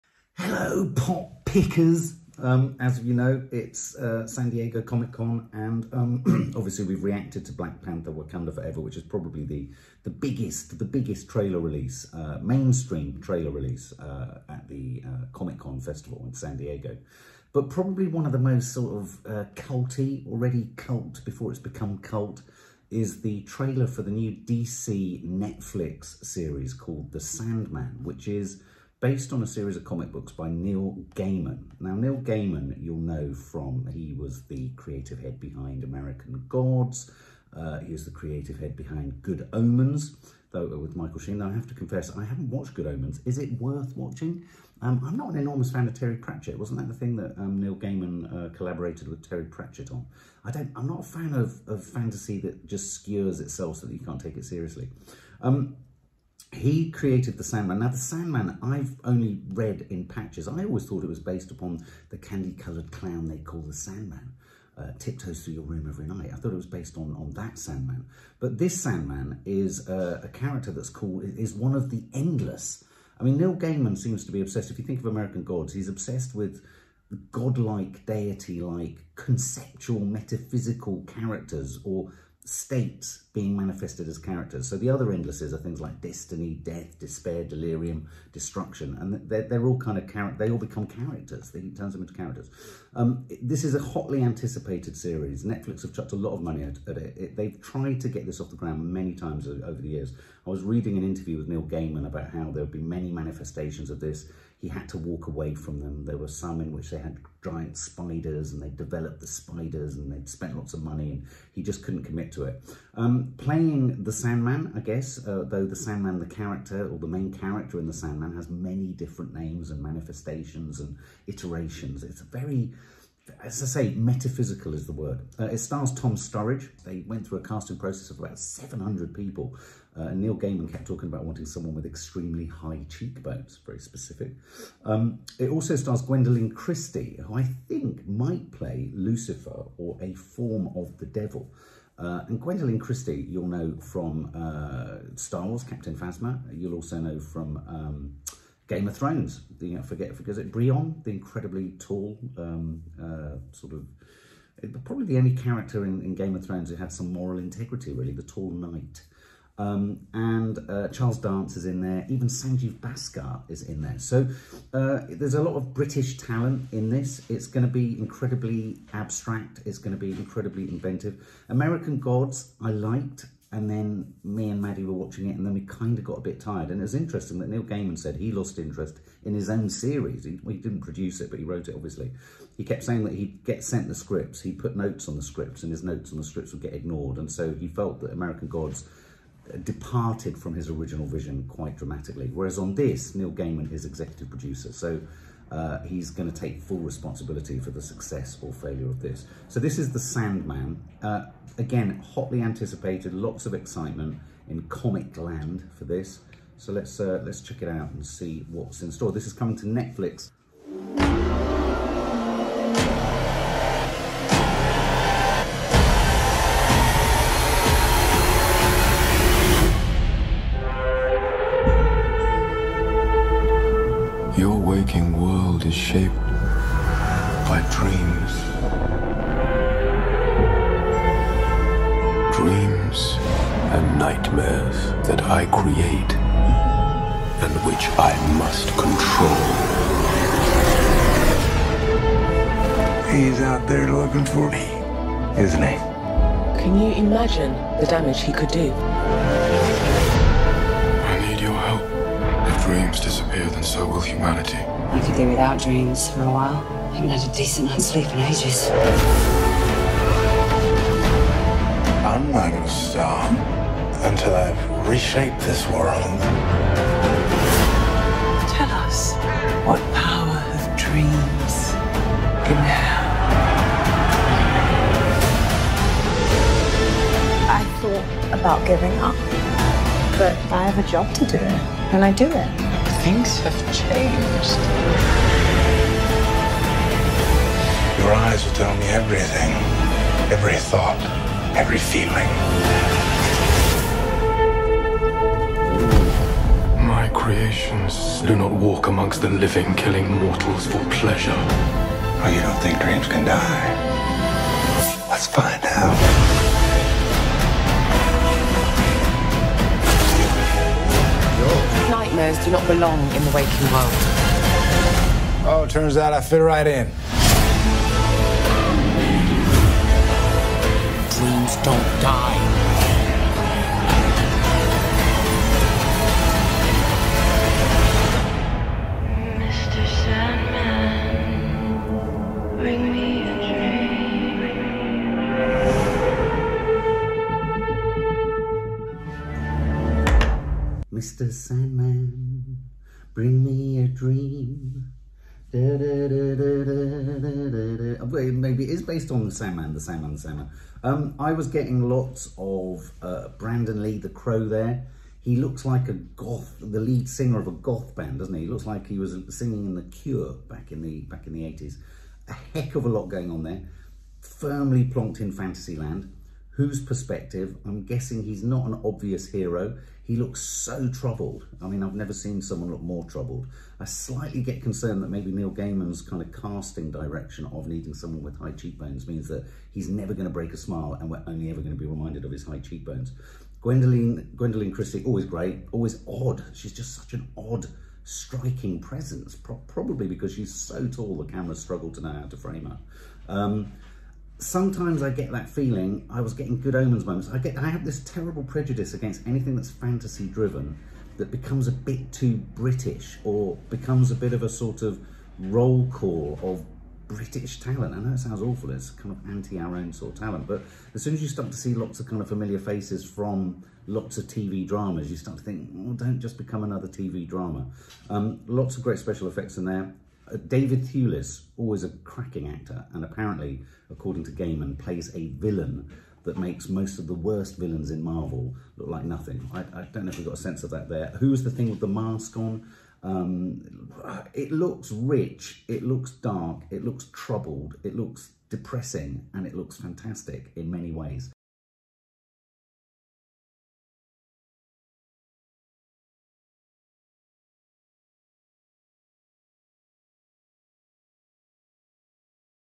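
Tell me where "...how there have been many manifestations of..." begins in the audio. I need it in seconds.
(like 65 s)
102 s.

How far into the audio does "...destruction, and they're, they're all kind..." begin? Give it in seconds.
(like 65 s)
88 s.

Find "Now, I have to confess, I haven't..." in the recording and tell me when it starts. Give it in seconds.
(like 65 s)
41 s.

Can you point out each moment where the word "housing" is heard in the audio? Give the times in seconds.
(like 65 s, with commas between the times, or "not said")
not said.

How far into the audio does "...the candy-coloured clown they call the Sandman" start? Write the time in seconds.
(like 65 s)
62 s.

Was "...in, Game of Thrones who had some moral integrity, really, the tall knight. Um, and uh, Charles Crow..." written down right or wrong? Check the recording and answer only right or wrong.
wrong.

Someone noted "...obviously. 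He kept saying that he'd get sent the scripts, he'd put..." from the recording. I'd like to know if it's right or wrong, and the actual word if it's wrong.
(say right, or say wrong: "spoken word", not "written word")
right.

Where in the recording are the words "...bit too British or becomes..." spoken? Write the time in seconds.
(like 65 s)
401 s.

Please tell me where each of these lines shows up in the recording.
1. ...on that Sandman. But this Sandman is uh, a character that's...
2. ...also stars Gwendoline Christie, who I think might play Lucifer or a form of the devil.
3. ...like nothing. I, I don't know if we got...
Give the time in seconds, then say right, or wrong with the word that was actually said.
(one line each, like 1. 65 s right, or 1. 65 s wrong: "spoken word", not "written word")
1. 67 s right
2. 135 s right
3. 428 s right.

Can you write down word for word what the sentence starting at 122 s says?
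It's a very as I say, metaphysical is the word.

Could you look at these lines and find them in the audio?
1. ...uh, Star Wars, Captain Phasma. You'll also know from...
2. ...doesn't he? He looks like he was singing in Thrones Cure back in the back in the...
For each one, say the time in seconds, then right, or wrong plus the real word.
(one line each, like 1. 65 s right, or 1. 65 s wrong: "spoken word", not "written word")
1. 144 s right
2. 358 s wrong: "The", not "Thrones".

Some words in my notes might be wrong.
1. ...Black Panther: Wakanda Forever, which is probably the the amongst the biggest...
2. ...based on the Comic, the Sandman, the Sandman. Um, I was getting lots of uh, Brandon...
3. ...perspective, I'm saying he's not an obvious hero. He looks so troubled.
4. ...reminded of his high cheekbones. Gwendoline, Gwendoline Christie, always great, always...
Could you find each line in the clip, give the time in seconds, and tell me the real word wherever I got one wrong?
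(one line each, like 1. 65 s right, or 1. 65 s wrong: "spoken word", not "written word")
1. 7 s wrong: "biggest", not "amongst"
2. 348 s wrong: "Sandman", not "Comic"
3. 366 s wrong: "guessing", not "saying"
4. 381 s right.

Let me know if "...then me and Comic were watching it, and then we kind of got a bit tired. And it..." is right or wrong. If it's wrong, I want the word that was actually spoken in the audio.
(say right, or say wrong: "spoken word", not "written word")
wrong: "Maddie", not "Comic".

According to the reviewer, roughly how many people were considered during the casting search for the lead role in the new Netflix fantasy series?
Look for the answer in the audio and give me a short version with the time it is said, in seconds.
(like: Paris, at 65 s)
700, at 128 s.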